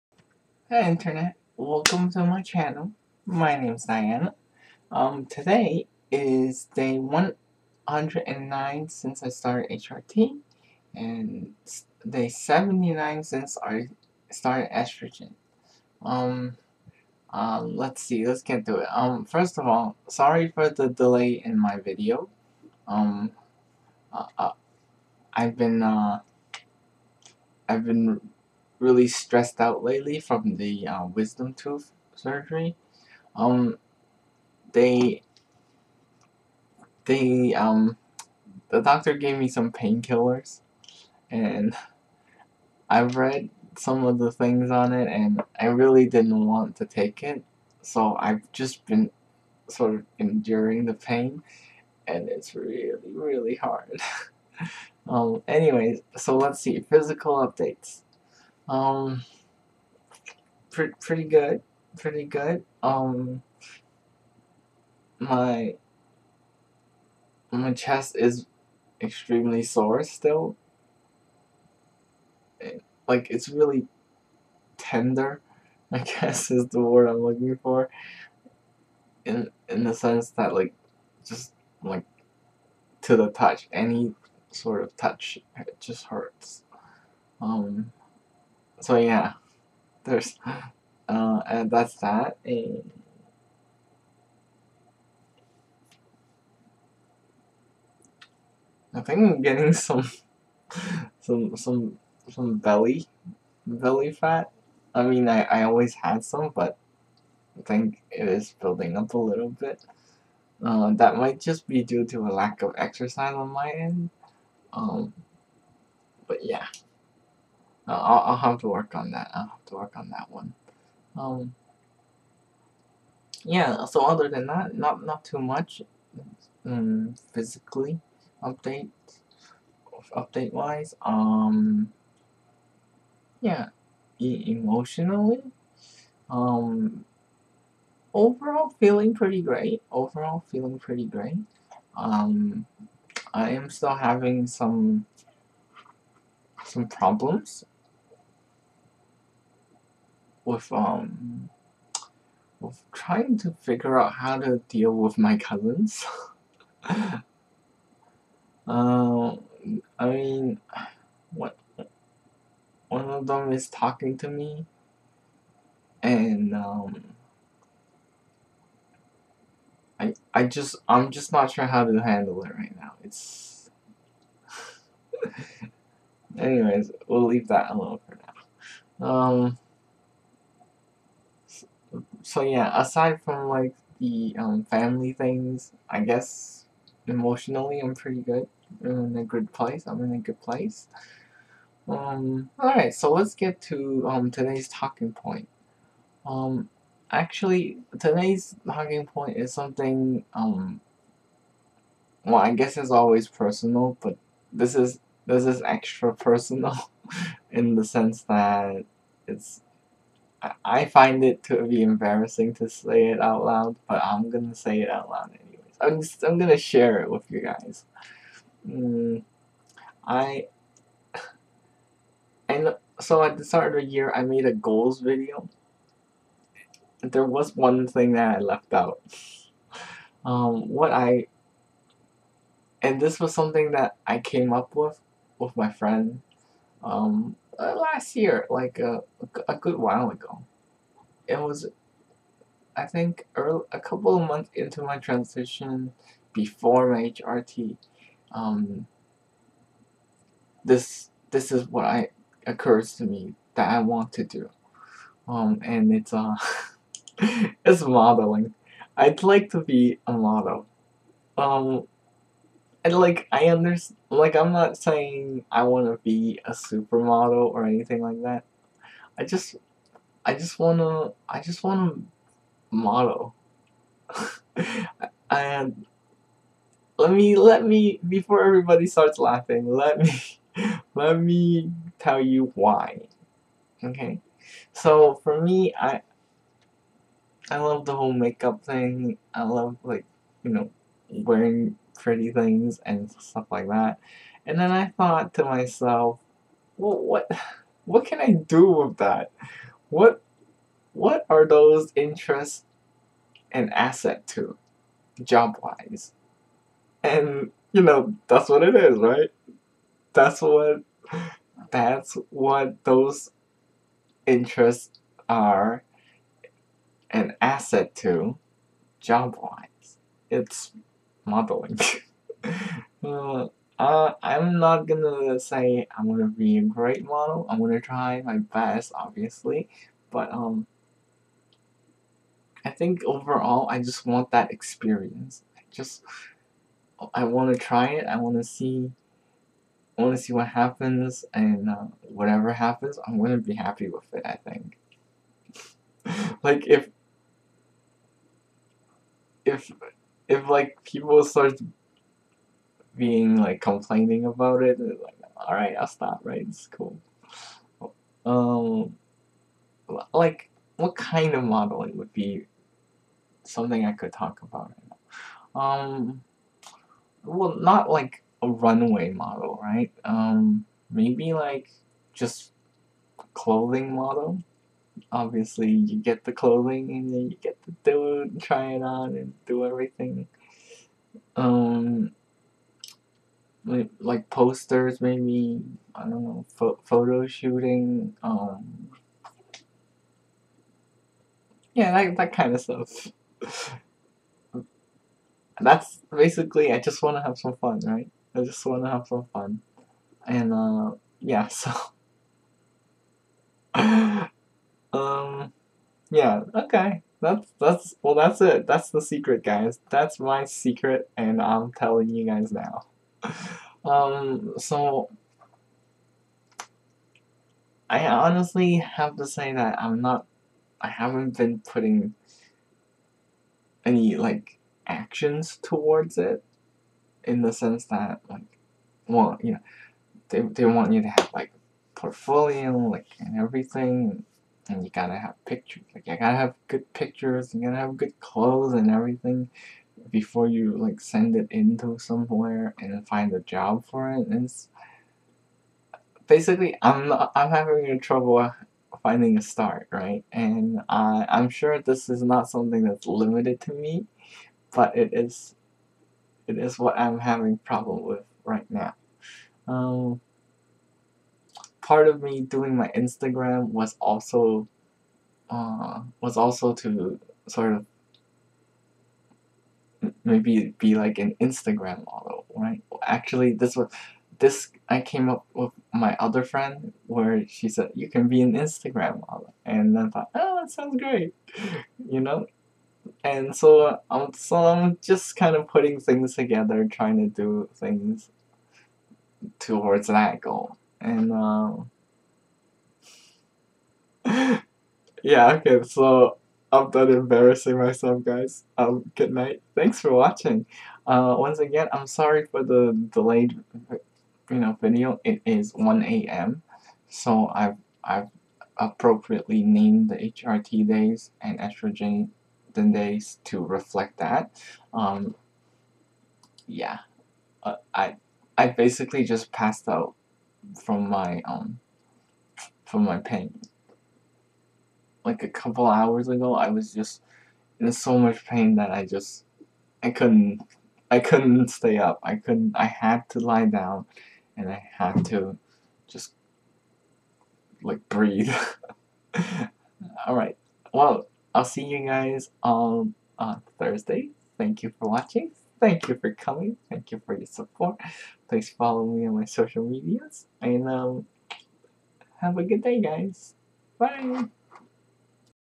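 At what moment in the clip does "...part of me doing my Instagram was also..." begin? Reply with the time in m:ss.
7:41.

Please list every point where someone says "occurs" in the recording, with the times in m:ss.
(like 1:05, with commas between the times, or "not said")
4:12.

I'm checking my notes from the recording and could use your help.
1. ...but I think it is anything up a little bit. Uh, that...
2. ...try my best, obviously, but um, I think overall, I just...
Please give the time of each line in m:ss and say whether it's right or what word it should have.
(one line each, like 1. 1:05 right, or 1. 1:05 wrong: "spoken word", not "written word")
1. 1:46 wrong: "building", not "anything"
2. 5:27 right.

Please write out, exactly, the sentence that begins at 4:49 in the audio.
I love like, you know, wearing pretty things and stuff like that.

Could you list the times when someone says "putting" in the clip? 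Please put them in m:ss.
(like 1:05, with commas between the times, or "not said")
7:01, 8:05.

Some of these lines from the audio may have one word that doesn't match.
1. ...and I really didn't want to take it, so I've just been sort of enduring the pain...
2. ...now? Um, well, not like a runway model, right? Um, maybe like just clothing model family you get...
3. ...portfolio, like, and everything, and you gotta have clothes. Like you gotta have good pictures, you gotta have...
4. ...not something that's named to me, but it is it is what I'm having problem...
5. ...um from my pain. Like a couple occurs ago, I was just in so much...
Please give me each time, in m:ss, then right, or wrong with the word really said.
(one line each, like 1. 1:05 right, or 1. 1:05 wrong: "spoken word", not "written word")
1. 0:45 right
2. 6:05 wrong: "obviously", not "family"
3. 7:11 wrong: "pictures", not "clothes"
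4. 7:32 wrong: "limited", not "named"
5. 8:41 wrong: "hours", not "occurs".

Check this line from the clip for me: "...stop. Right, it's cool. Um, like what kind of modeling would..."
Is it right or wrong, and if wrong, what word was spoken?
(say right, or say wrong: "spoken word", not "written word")
right.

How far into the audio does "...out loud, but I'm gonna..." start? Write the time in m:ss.
3:33.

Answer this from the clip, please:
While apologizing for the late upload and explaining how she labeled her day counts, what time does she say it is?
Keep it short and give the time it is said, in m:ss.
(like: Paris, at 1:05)
1 a.m., at 8:25.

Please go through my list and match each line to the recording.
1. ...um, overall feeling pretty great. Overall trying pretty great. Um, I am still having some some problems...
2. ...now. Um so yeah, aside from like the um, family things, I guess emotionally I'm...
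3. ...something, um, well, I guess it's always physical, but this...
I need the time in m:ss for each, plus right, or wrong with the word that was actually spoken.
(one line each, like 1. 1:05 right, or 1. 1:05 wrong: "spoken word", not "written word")
1. 2:16 wrong: "feeling", not "trying"
2. 2:59 right
3. 3:19 wrong: "personal", not "physical".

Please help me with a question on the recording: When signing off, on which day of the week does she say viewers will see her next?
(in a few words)
Thursday.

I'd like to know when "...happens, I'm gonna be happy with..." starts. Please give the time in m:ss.
5:42.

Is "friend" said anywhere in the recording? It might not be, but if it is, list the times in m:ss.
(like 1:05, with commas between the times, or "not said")
3:55, 7:56.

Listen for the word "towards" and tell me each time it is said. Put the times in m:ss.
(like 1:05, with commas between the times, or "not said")
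7:05, 8:09.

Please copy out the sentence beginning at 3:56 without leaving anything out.
Um, uh, last year, like a, uh, a good while ago.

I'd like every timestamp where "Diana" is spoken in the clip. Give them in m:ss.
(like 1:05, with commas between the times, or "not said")
0:03.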